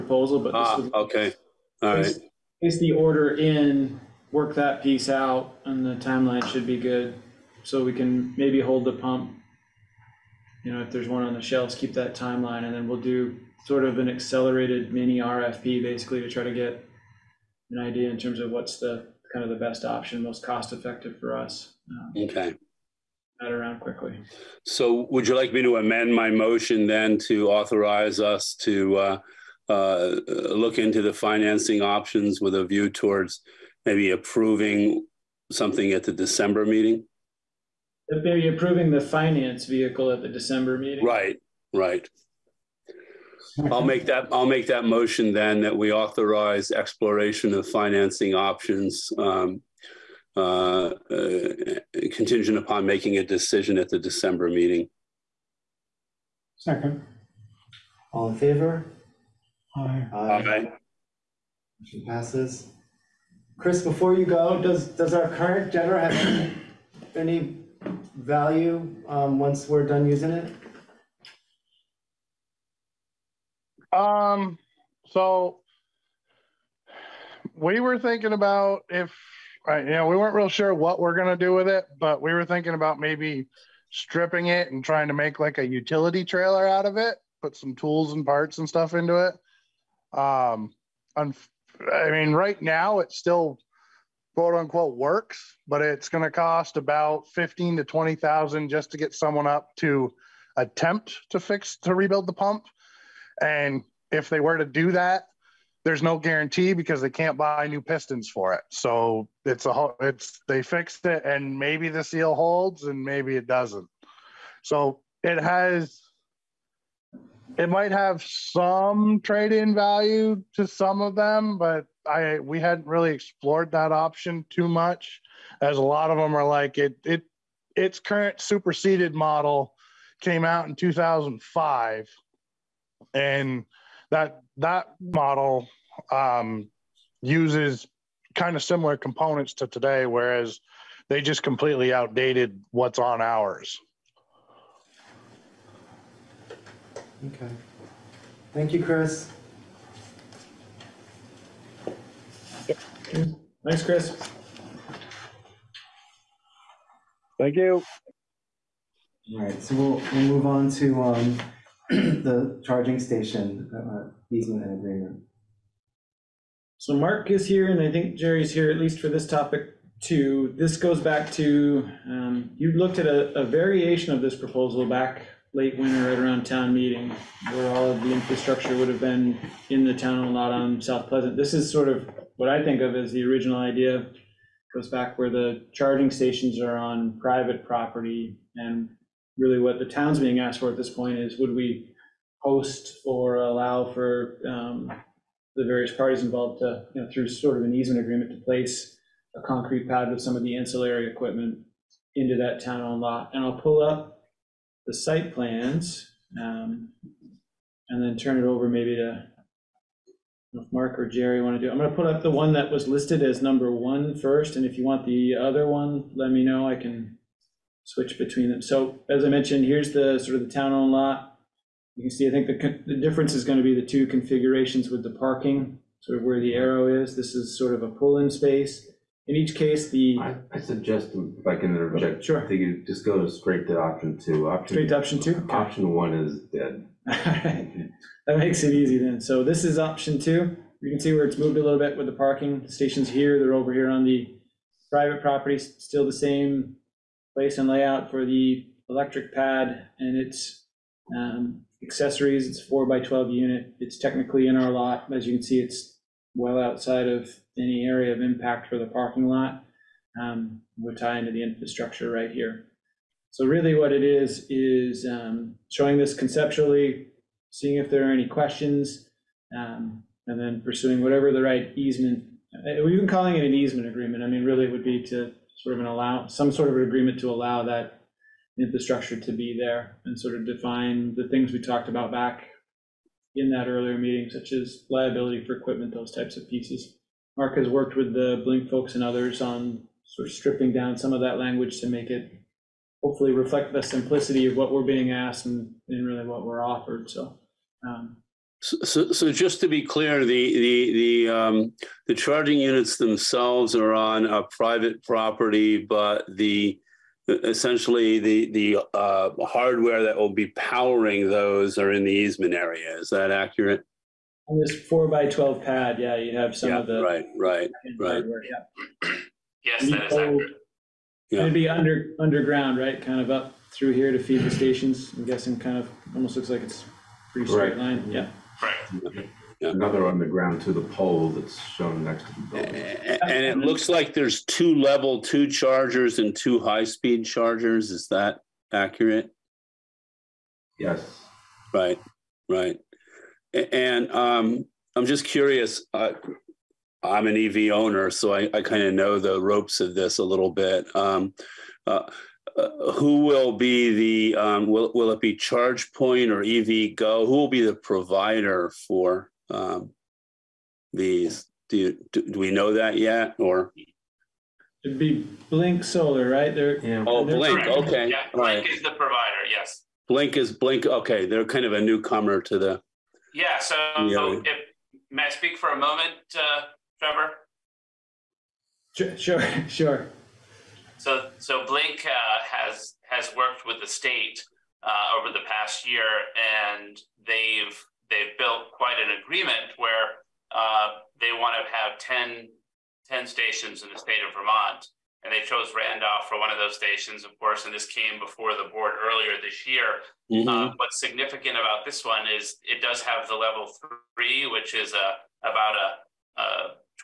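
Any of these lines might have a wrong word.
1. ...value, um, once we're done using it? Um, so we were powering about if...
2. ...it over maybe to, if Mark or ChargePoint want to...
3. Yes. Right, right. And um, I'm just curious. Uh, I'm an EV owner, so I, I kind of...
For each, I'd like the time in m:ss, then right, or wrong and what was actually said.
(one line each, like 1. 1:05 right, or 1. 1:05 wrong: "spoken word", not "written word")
1. 1:08 wrong: "thinking", not "powering"
2. 3:28 wrong: "Jerry", not "ChargePoint"
3. 5:40 right.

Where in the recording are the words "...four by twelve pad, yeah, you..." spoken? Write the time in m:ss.
5:14.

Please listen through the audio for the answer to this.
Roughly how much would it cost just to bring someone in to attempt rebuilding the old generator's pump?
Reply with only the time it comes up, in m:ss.
1:37.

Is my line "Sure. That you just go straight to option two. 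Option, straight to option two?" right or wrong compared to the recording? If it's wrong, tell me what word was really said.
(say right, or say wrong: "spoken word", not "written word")
right.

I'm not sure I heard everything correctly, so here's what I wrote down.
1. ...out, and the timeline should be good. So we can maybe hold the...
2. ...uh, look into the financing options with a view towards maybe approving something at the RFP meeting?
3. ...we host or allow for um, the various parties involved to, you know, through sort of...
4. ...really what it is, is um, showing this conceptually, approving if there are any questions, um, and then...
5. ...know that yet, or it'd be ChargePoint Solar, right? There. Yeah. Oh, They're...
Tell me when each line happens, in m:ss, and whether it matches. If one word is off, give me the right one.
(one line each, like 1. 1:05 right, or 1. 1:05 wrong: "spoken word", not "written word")
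1. 0:05 right
2. 0:29 wrong: "December", not "RFP"
3. 3:11 right
4. 4:23 wrong: "seeing", not "approving"
5. 6:02 wrong: "Blink", not "ChargePoint".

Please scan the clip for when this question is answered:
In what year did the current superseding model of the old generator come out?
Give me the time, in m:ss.
2:10.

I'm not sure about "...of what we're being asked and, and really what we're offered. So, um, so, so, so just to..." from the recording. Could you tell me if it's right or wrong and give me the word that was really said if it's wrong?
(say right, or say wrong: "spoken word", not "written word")
right.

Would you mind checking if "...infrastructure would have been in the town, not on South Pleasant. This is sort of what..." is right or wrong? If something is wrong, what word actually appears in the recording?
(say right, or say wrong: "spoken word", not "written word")
right.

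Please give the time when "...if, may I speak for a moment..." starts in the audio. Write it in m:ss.
6:14.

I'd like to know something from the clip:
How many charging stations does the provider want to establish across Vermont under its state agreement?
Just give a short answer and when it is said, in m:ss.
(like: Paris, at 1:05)
10, at 6:33.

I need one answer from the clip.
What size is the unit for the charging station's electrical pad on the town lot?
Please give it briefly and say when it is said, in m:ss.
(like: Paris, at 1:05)
4 by 12, at 4:12.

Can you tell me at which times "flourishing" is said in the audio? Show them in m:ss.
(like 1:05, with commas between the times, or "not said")
not said.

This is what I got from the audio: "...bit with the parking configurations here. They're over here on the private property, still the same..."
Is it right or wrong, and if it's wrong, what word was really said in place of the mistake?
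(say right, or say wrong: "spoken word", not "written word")
wrong: "stations", not "configurations".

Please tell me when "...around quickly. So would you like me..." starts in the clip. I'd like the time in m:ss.
0:23.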